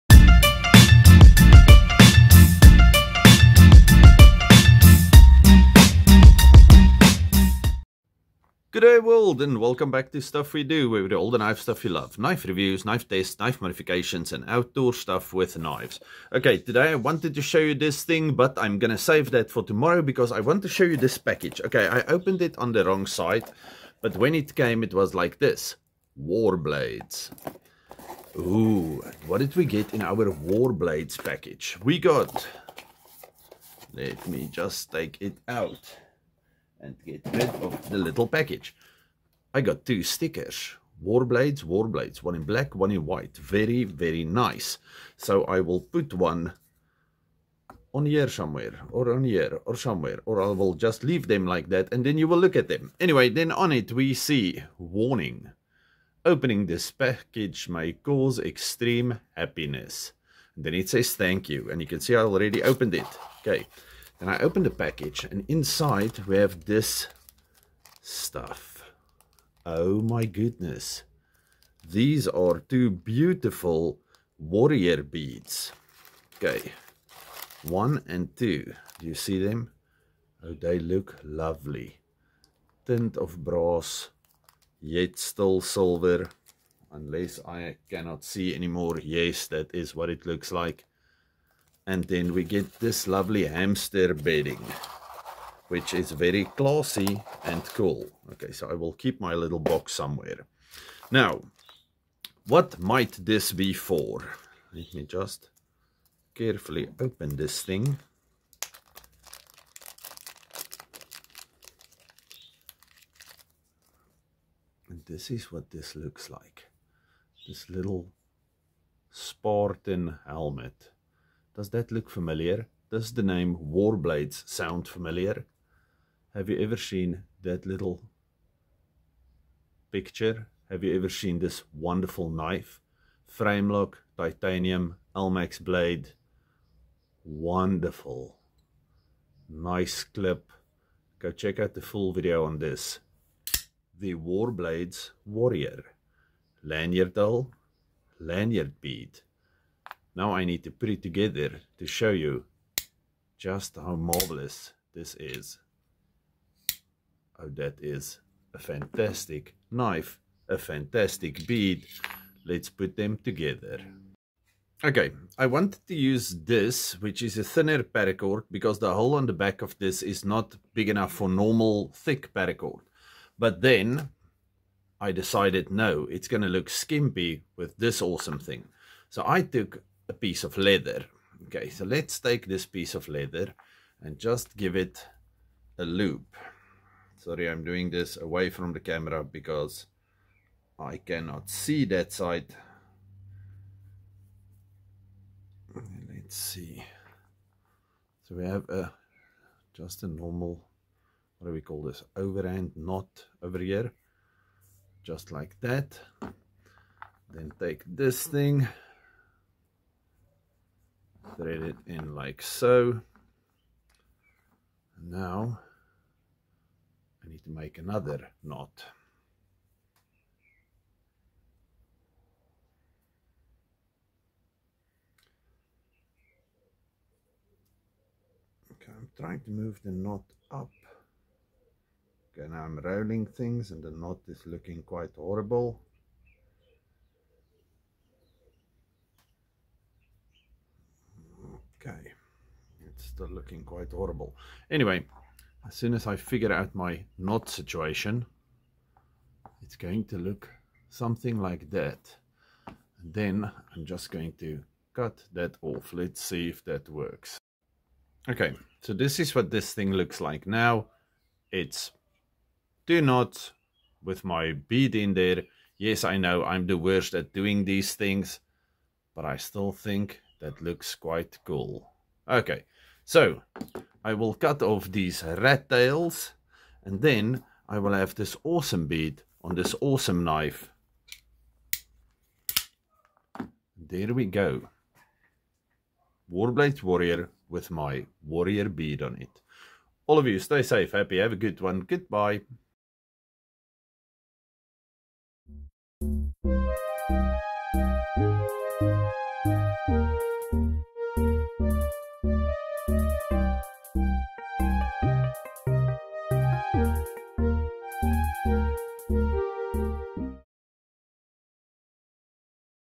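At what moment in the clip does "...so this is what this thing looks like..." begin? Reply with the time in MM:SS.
04:18.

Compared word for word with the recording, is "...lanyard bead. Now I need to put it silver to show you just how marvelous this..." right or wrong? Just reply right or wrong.
wrong.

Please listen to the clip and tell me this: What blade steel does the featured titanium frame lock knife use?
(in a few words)
Elmax.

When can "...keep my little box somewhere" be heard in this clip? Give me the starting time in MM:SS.
01:38.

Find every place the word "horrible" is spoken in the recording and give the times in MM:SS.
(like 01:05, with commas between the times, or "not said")
03:55, 04:03.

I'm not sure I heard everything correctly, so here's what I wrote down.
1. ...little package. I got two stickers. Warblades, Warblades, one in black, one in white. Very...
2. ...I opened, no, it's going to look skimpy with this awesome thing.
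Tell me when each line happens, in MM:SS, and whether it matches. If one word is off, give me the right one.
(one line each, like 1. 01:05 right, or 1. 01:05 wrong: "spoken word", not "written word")
1. 00:37 right
2. 02:54 wrong: "decided", not "opened".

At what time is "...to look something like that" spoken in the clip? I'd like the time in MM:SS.
04:10.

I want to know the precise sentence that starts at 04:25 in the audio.
Yes, I know I'm the worst at doing these things, but I still think that looks quite cool.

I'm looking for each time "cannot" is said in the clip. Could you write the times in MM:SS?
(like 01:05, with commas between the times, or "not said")
01:27, 03:10.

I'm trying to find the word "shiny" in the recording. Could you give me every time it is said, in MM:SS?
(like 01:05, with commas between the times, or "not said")
not said.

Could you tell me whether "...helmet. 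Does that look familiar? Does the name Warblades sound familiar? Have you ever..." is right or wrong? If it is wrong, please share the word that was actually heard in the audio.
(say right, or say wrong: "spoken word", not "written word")
right.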